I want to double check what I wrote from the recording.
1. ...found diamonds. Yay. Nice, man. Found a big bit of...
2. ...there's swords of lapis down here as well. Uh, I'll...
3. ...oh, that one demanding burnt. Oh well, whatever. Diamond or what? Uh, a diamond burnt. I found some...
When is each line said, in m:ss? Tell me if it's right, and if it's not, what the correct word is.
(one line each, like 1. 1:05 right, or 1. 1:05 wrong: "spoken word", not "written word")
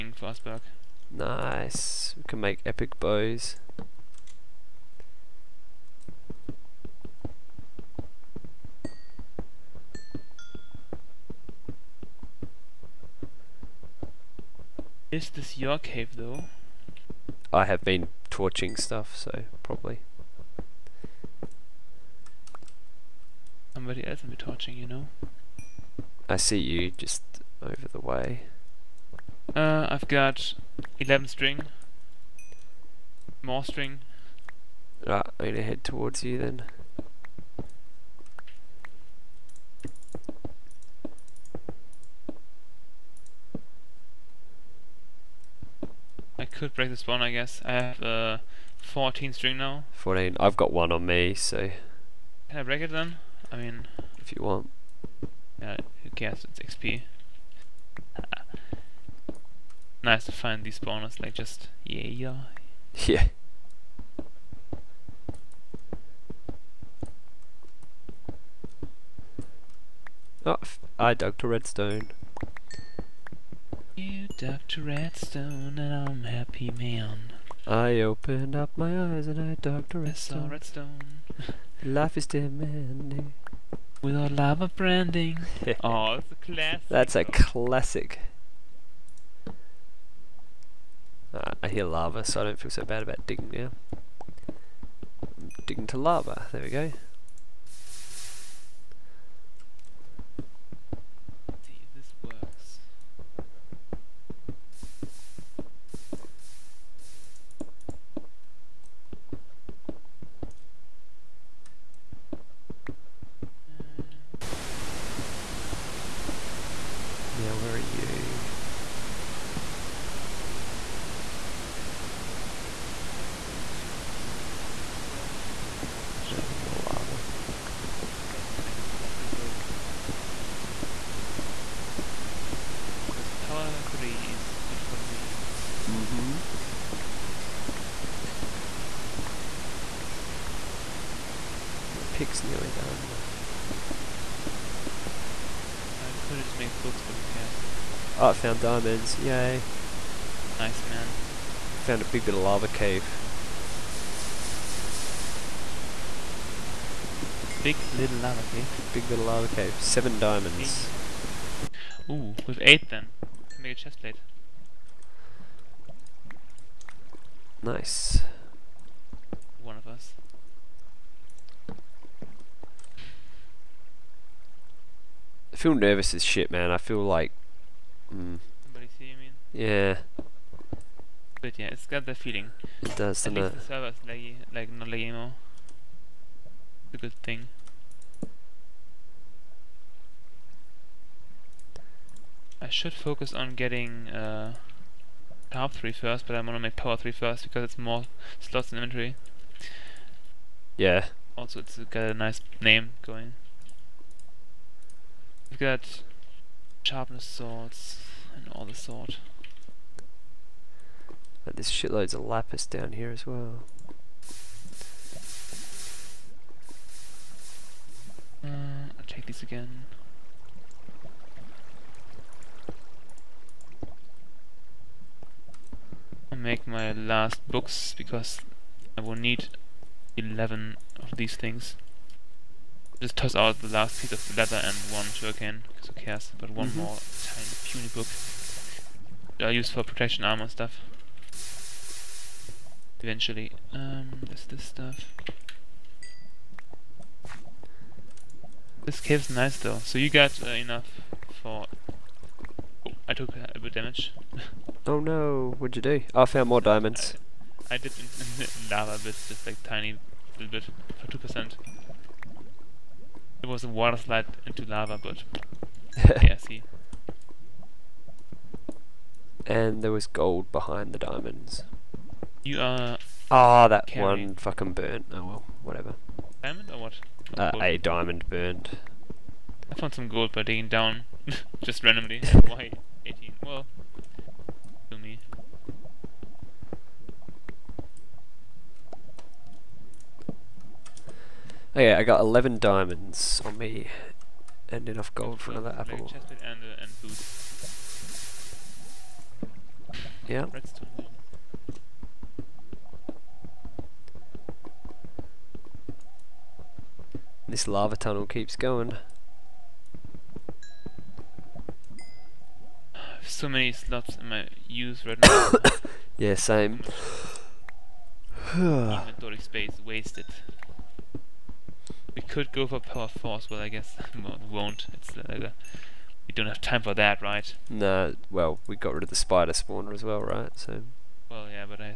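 1. 2:28 right
2. 3:31 wrong: "shitloads", not "swords"
3. 4:33 wrong: "fucking", not "demanding".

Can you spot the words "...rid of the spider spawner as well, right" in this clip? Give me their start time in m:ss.
5:28.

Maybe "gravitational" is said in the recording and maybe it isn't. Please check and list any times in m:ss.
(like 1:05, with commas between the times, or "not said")
not said.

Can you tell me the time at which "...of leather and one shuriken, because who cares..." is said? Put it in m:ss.
3:54.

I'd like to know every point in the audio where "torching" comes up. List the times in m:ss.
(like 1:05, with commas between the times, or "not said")
0:18, 0:24.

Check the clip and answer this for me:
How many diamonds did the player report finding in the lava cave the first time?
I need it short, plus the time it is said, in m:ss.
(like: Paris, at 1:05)
7, at 2:39.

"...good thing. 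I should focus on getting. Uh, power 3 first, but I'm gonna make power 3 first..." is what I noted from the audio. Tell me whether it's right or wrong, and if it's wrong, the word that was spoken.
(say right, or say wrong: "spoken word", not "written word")
right.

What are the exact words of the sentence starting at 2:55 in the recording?
I feel nervous as shit, man.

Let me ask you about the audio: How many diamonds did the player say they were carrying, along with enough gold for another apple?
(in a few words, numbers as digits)
11.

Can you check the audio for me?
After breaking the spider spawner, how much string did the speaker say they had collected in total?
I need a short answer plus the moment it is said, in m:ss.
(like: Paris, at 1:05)
14, at 0:48.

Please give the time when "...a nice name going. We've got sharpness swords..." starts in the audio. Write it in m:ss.
3:22.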